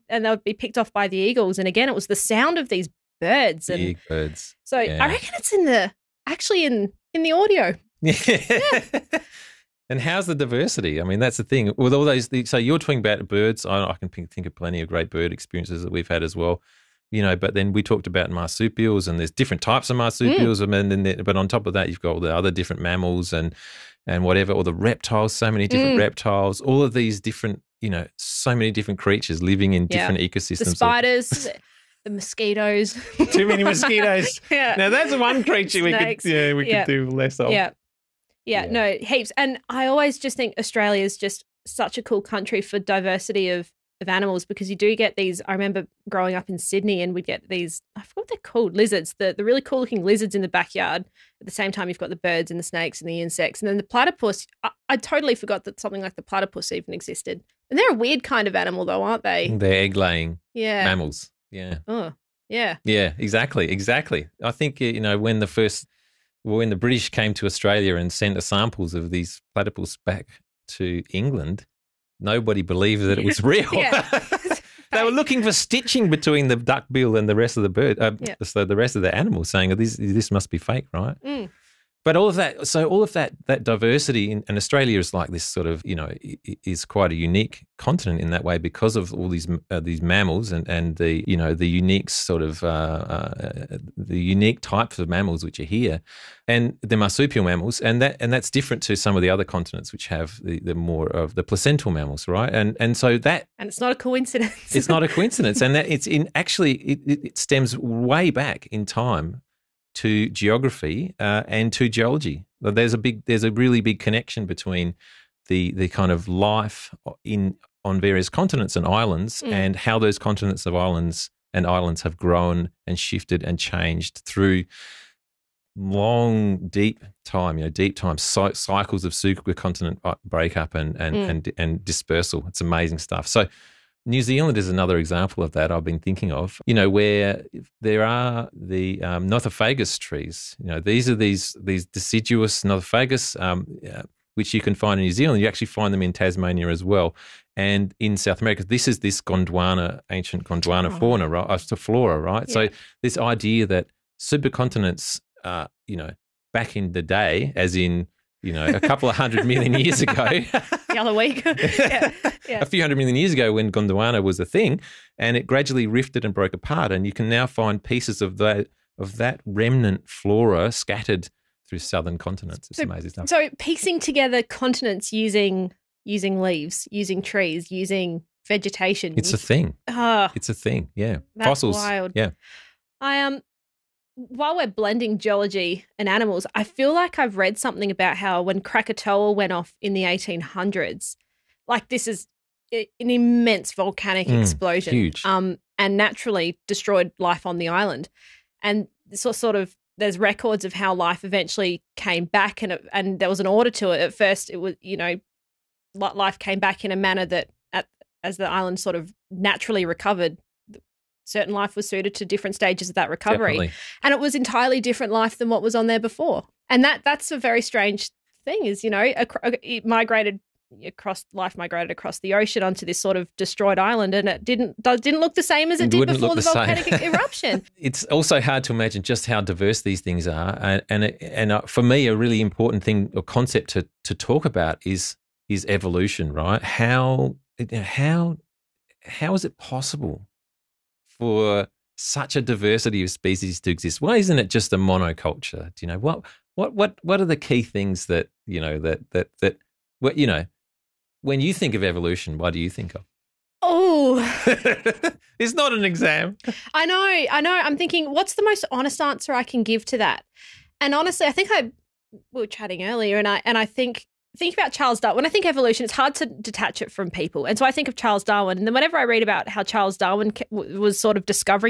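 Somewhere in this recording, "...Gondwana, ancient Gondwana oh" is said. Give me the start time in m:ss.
2:29.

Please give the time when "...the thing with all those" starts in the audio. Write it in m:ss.
0:11.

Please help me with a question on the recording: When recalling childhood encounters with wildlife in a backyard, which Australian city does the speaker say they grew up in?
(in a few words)
Sydney.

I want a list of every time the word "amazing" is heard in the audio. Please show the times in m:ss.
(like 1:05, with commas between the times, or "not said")
2:12, 2:52.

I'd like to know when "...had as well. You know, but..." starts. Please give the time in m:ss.
0:16.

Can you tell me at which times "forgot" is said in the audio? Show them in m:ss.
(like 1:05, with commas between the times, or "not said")
0:48, 0:55.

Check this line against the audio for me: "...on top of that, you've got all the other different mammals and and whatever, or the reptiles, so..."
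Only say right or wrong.
right.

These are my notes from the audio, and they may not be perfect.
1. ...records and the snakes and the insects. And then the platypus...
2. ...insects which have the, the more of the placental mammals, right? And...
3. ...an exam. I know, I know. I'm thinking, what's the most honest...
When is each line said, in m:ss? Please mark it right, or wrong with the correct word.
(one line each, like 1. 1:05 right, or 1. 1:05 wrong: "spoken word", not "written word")
1. 0:52 wrong: "birds", not "records"
2. 1:39 wrong: "continents", not "insects"
3. 4:15 right.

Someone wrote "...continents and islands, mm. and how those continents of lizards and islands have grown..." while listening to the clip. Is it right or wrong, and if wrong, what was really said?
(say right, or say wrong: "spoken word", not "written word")
wrong: "islands", not "lizards".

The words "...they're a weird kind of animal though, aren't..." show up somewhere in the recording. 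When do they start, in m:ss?
0:57.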